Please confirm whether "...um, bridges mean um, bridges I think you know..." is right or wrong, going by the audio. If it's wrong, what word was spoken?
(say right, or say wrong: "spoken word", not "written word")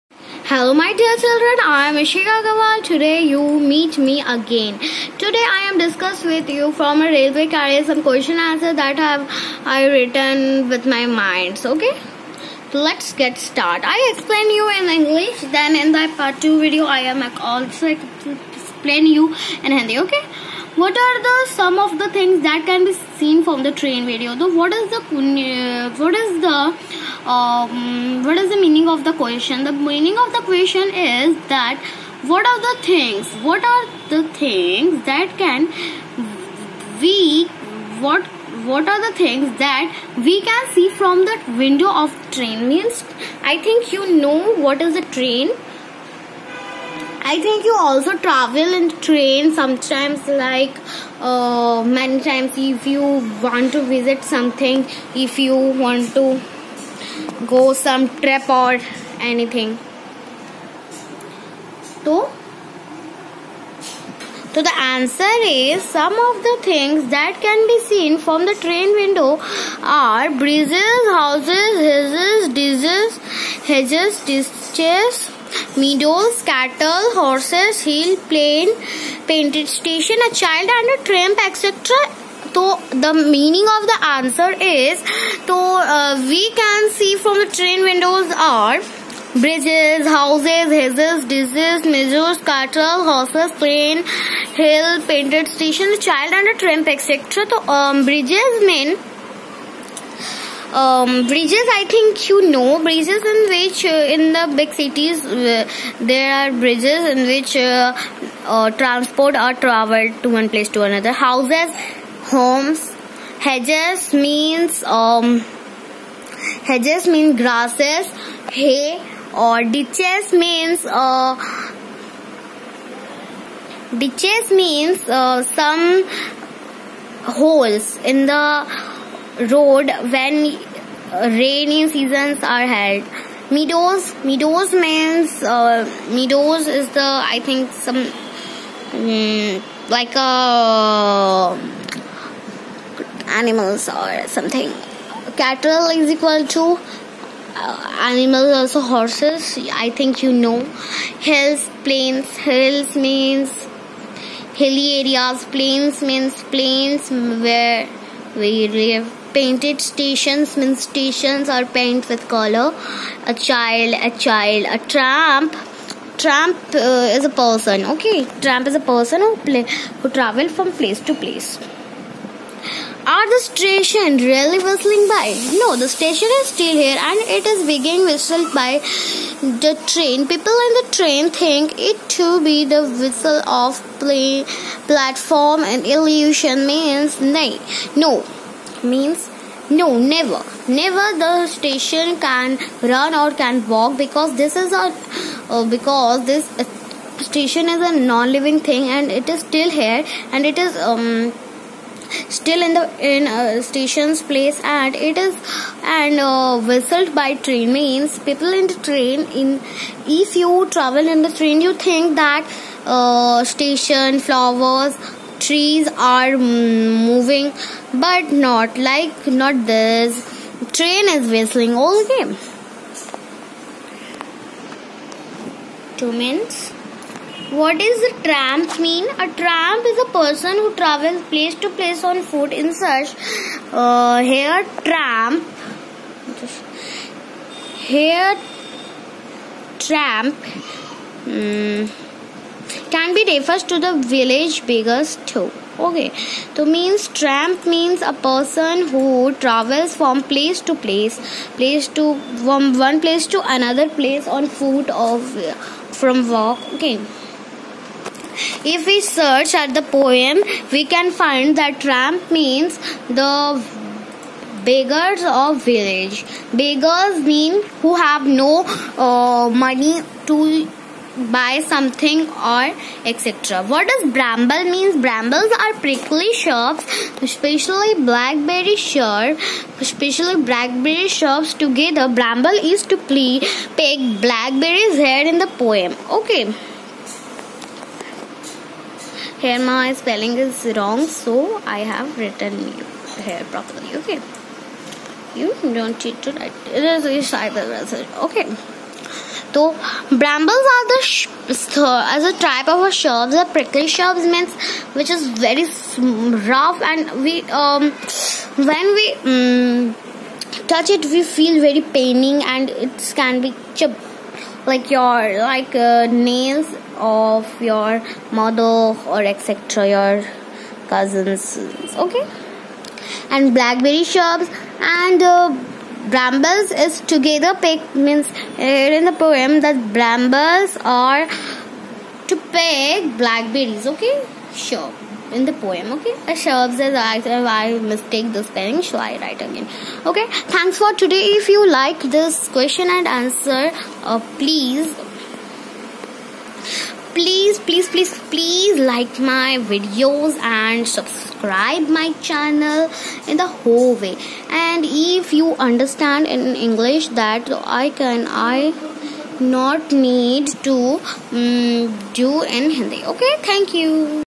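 right.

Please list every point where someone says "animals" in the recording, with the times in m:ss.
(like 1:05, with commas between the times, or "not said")
2:23, 2:27.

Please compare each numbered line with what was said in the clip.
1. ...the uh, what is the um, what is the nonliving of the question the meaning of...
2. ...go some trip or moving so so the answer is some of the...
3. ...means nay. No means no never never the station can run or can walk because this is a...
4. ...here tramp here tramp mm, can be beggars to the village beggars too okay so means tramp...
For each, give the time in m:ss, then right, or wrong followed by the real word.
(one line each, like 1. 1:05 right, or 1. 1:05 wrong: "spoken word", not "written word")
1. 0:24 wrong: "meaning", not "nonliving"
2. 0:57 wrong: "anything", not "moving"
3. 3:06 right
4. 3:54 wrong: "refers", not "beggars".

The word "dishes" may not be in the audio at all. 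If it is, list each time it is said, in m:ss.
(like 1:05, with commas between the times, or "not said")
1:12, 1:31.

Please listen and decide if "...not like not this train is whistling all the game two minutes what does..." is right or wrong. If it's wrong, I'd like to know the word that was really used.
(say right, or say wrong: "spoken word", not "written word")
right.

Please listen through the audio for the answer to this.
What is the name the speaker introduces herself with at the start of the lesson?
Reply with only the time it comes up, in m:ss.
0:01.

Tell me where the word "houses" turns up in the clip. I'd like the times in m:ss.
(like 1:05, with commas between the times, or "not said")
1:11, 1:30, 1:51.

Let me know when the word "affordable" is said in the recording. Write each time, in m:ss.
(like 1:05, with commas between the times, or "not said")
not said.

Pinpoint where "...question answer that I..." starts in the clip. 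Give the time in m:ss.
0:08.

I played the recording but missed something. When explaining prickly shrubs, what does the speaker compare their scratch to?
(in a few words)
your mother.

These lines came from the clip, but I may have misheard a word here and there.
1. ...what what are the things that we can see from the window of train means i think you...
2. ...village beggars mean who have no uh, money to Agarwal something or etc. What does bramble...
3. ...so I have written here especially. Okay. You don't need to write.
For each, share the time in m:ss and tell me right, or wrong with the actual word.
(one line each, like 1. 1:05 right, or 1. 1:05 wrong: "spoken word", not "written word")
1. 0:37 right
2. 4:25 wrong: "Buy", not "Agarwal"
3. 4:51 wrong: "properly", not "especially".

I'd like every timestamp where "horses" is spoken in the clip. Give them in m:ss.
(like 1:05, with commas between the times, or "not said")
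1:17, 1:33, 2:28.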